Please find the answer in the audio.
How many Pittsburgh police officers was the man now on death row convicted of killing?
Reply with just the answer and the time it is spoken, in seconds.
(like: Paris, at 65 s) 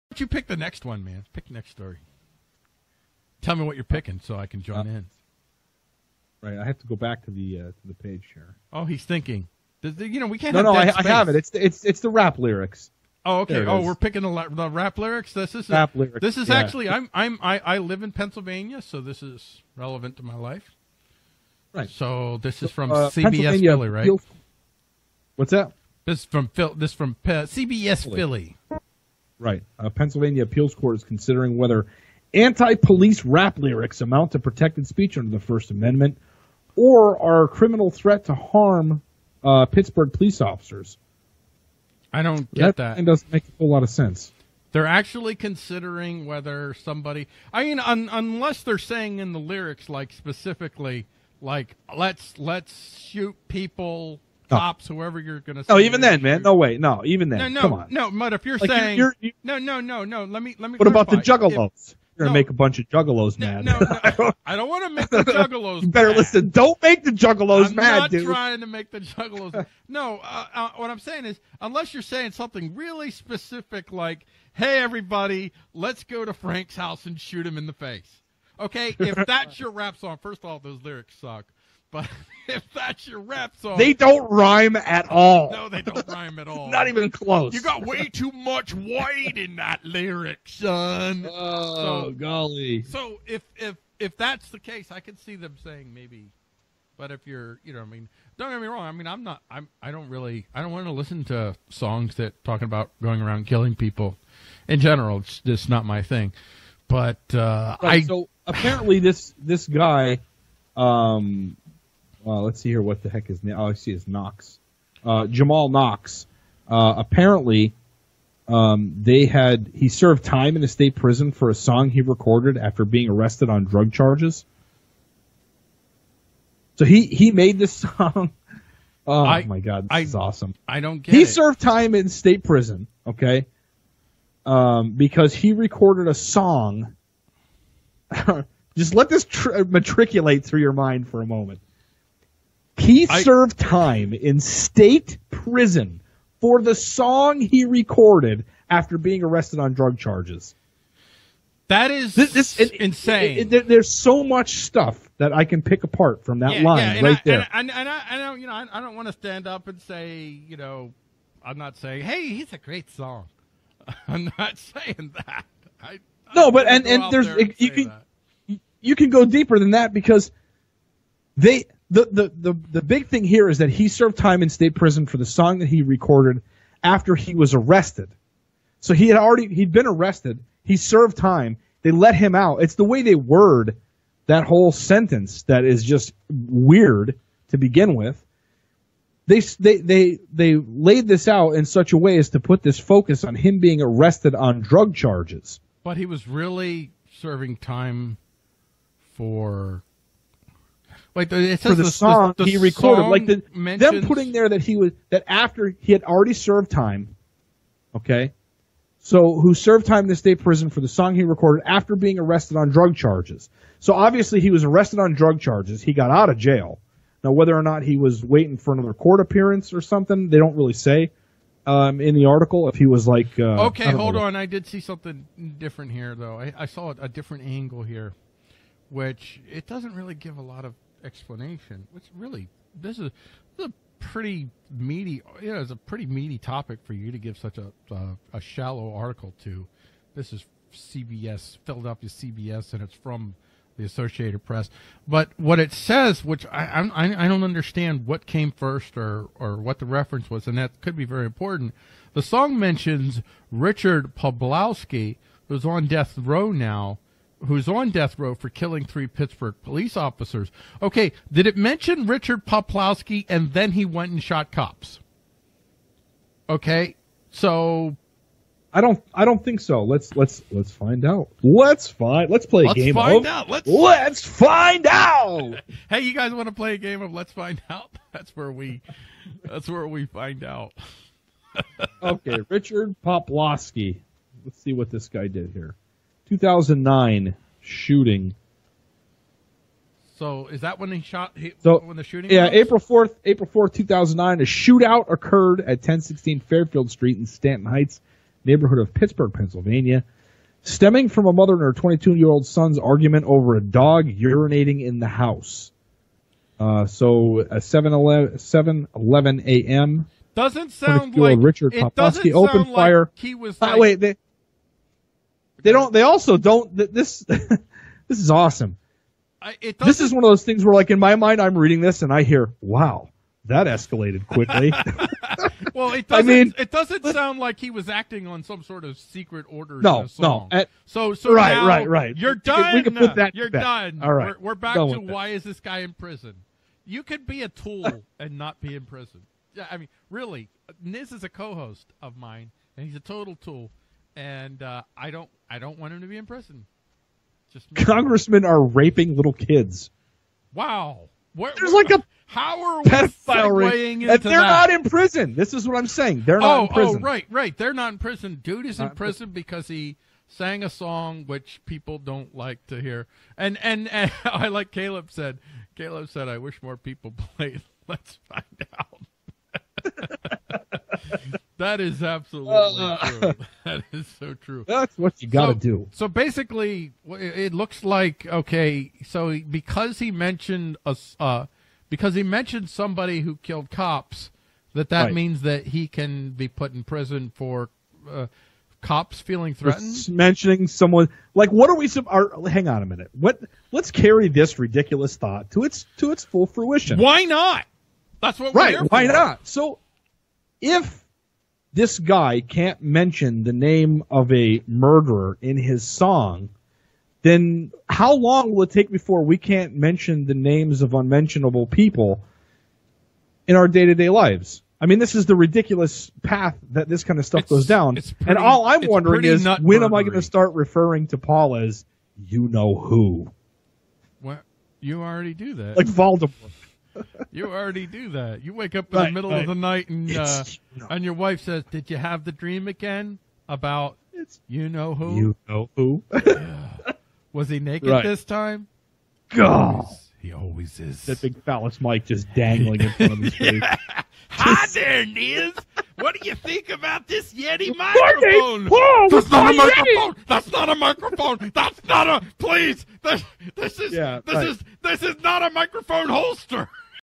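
3, at 258 s.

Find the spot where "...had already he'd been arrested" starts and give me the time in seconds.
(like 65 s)
179 s.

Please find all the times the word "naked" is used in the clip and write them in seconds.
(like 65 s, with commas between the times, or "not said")
437 s.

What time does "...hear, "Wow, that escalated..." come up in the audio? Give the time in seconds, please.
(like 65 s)
322 s.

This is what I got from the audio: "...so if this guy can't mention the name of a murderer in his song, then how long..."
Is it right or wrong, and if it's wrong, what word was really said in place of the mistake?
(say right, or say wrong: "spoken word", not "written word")
right.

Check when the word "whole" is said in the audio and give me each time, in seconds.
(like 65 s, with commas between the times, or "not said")
43 s, 184 s.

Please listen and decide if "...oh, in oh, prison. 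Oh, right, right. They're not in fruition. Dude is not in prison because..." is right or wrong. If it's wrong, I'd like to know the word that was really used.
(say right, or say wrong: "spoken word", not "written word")
wrong: "prison", not "fruition".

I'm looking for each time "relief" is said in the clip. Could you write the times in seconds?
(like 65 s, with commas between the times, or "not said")
not said.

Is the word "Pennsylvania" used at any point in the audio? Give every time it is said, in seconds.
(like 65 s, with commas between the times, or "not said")
18 s, 29 s, 299 s.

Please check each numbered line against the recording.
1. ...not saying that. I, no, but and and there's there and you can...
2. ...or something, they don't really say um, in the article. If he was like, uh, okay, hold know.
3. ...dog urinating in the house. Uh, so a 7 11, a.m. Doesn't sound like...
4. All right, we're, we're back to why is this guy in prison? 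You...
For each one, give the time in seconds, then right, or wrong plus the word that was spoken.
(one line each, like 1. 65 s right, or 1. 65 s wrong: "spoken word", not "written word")
1. 164 s right
2. 219 s right
3. 303 s right
4. 334 s right.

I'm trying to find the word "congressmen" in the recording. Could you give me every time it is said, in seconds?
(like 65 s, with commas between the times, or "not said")
347 s.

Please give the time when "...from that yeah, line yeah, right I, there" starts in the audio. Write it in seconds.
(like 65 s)
156 s.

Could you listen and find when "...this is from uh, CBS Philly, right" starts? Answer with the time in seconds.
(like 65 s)
22 s.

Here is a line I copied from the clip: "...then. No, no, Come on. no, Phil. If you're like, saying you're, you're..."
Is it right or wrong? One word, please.
wrong.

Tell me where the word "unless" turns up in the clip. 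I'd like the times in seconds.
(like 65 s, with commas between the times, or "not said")
48 s, 71 s.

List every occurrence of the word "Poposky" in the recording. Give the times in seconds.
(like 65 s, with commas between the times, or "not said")
311 s.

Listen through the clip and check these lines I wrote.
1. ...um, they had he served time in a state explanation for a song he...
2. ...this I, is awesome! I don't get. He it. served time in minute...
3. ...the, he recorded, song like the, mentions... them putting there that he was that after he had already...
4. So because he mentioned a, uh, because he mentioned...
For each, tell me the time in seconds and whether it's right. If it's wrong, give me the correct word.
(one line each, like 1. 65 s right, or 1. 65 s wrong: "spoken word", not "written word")
1. 118 s wrong: "prison", not "explanation"
2. 129 s wrong: "state", not "minute"
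3. 202 s right
4. 379 s right.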